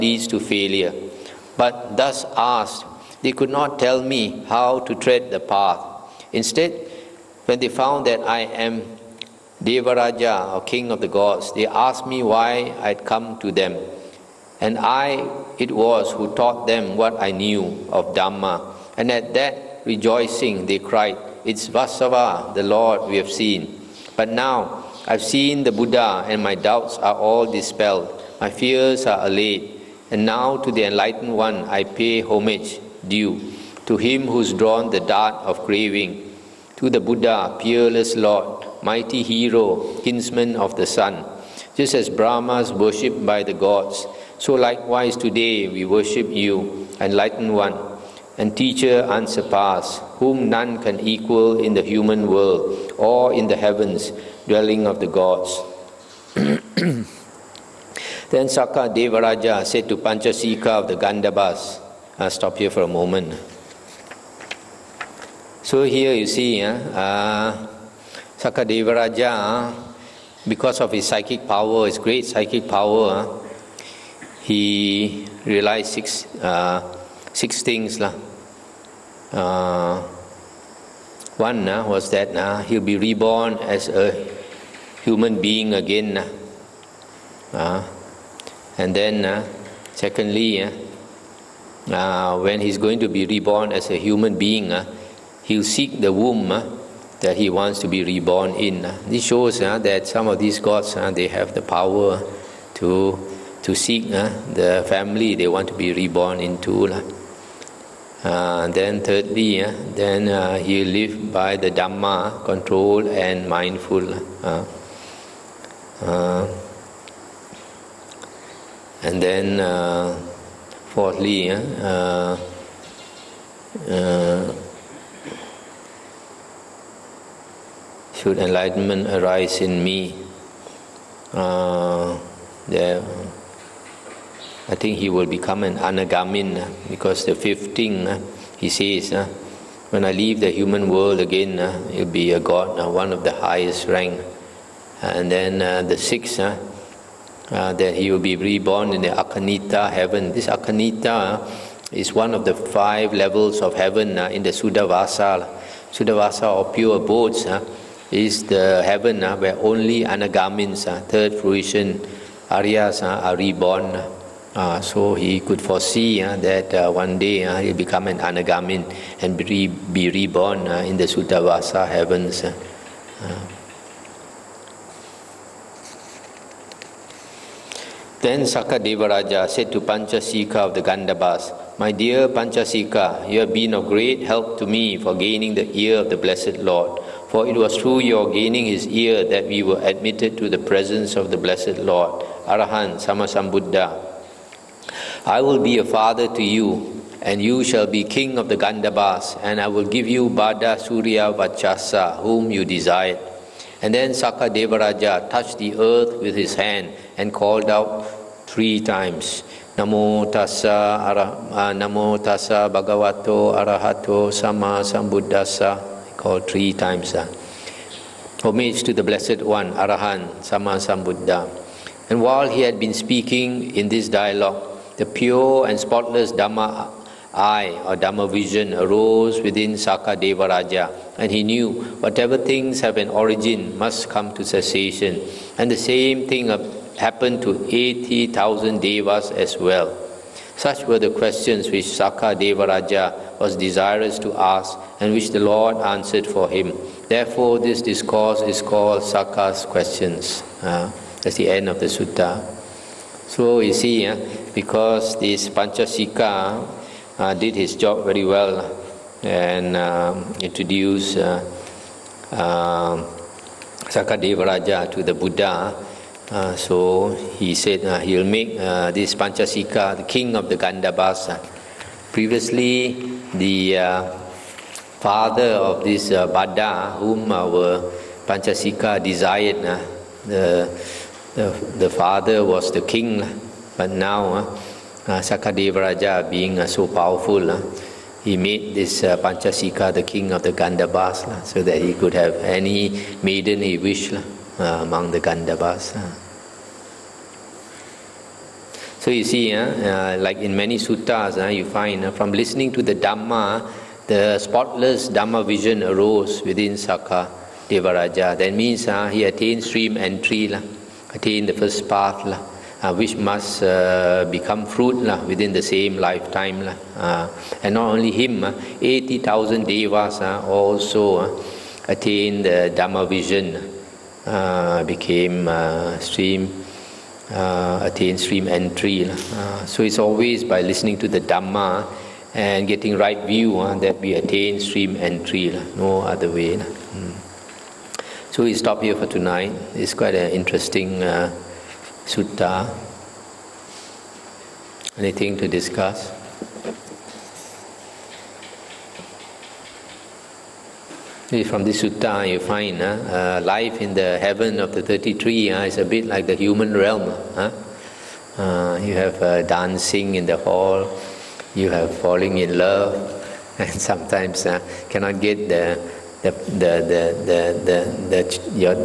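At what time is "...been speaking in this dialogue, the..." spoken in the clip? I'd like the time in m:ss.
3:42.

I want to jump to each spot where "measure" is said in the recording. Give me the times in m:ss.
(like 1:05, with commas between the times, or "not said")
not said.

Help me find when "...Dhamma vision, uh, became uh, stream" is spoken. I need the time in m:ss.
5:22.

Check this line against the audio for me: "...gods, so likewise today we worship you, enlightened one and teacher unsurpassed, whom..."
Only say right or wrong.
right.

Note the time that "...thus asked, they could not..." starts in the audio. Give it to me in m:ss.
0:01.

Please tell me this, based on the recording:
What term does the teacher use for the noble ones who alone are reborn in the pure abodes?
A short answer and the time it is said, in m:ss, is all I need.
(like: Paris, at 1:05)
anagamins, at 2:40.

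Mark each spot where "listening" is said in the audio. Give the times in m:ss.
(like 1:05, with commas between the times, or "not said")
5:02, 5:30.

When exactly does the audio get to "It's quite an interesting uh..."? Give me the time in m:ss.
5:39.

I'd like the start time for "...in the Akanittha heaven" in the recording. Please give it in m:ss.
2:28.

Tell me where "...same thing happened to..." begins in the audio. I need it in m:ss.
3:55.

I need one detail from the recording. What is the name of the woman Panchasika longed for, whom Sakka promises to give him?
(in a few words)
Bhadda Surya Vaccasa.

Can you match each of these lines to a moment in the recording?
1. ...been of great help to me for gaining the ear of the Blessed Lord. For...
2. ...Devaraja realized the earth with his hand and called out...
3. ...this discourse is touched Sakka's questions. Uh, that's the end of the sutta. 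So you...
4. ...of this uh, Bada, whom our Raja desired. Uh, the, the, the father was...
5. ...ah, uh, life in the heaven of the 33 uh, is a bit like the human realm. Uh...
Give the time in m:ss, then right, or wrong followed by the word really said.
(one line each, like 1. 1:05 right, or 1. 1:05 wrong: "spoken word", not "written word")
1. 3:03 right
2. 3:24 wrong: "touched", not "realized"
3. 4:07 wrong: "called", not "touched"
4. 4:35 wrong: "Panchasika", not "Raja"
5. 5:52 right.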